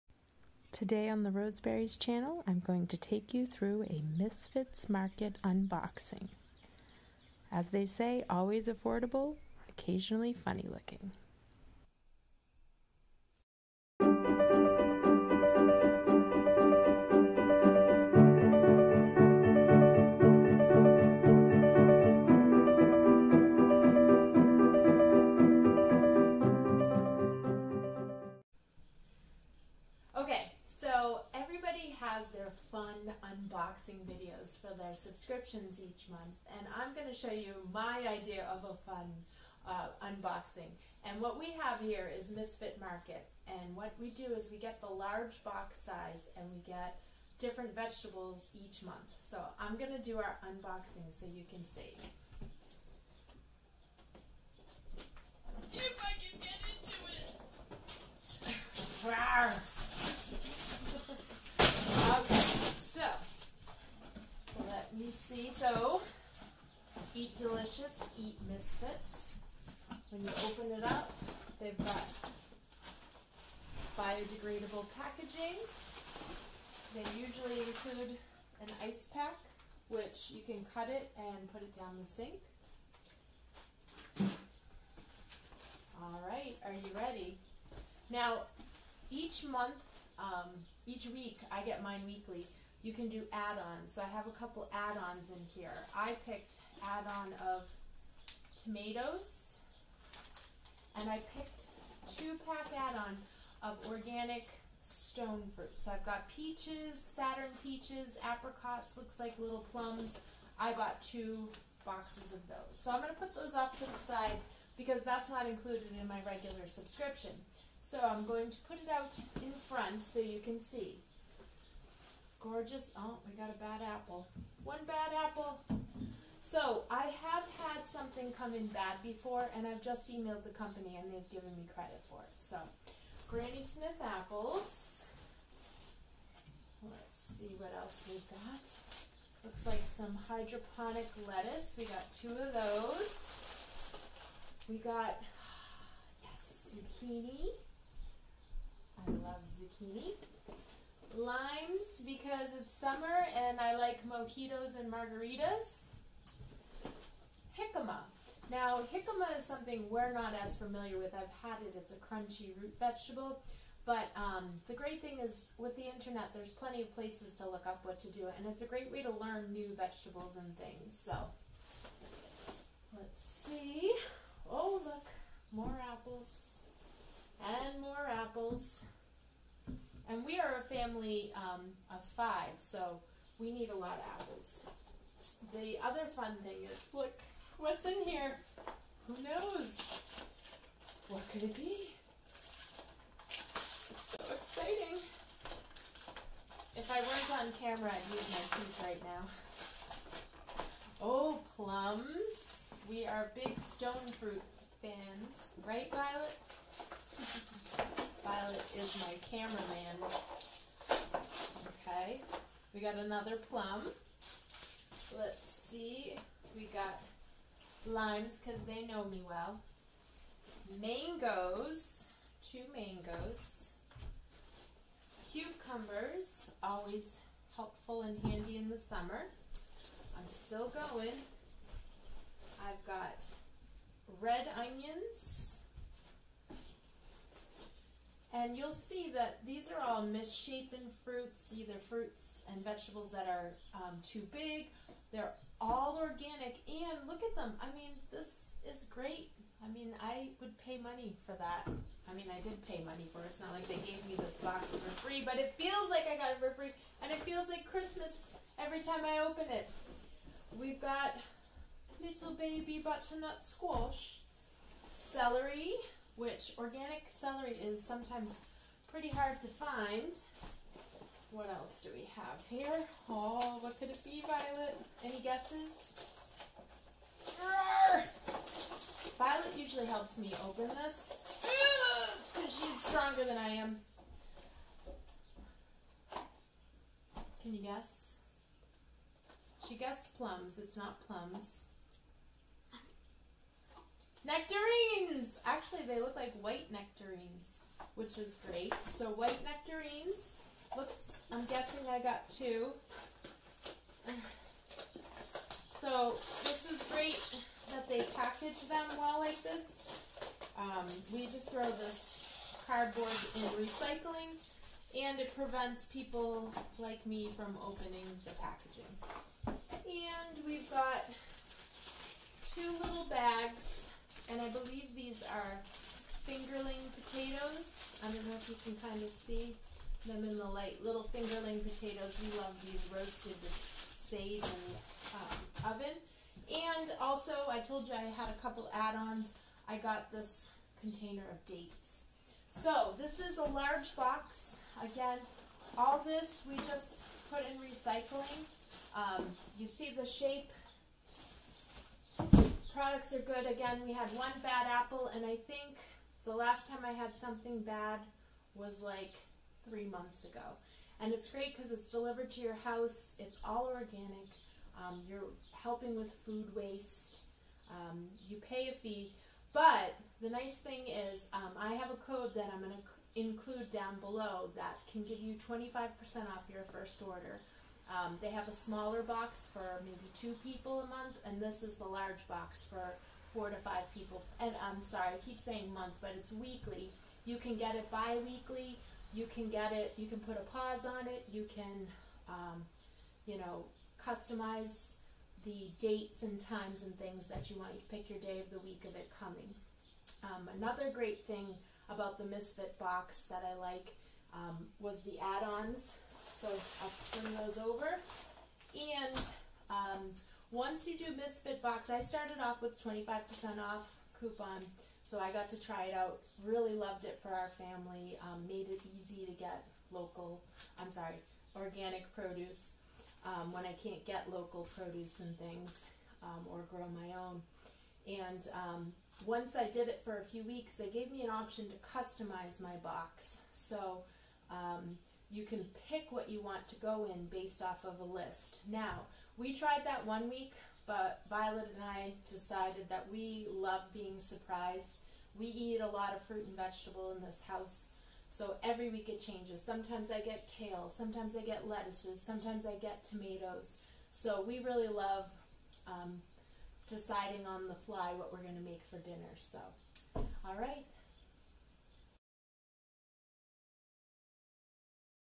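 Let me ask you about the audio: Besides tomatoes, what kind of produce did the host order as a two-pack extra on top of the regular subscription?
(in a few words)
Organic stone fruit.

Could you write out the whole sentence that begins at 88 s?
Now, each month, um, each week, I get mine weekly.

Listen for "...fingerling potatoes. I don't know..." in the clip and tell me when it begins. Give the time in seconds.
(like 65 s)
326 s.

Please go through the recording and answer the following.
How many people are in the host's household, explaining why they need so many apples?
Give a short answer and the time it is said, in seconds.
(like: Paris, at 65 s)
5, at 180 s.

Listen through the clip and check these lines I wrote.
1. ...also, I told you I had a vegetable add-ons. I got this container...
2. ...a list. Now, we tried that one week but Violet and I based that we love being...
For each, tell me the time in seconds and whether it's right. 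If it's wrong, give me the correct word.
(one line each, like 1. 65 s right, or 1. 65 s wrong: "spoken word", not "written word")
1. 336 s wrong: "couple", not "vegetable"
2. 437 s wrong: "decided", not "based".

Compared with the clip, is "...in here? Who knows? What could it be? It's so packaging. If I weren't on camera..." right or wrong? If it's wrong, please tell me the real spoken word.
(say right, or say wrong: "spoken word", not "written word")
wrong: "exciting", not "packaging".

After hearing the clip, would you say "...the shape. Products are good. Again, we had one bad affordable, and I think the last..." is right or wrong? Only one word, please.
wrong.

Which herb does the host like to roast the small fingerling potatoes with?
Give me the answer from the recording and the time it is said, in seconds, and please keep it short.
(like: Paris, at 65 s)
Sage, at 333 s.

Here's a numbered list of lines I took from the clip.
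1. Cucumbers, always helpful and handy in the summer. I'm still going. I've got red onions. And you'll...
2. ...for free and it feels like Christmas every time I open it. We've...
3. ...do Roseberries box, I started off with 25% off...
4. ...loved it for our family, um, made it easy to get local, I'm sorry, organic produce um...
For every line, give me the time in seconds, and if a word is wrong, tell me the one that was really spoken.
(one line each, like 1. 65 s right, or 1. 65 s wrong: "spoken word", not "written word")
1. 225 s right
2. 256 s right
3. 410 s wrong: "Misfit", not "Roseberries"
4. 416 s right.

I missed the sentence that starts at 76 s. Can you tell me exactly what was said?
They usually include an ice pack, which you can cut it and put it down the sink.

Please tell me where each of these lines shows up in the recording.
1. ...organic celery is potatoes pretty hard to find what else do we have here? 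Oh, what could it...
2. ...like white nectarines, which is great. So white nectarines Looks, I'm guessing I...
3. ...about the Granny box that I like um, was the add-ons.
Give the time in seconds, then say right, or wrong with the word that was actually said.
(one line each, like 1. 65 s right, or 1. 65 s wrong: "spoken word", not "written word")
1. 266 s wrong: "sometimes", not "potatoes"
2. 296 s right
3. 401 s wrong: "Misfit", not "Granny".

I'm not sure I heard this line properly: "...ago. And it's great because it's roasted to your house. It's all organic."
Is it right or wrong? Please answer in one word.
wrong.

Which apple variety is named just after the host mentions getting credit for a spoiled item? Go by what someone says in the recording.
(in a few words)
Granny Smith.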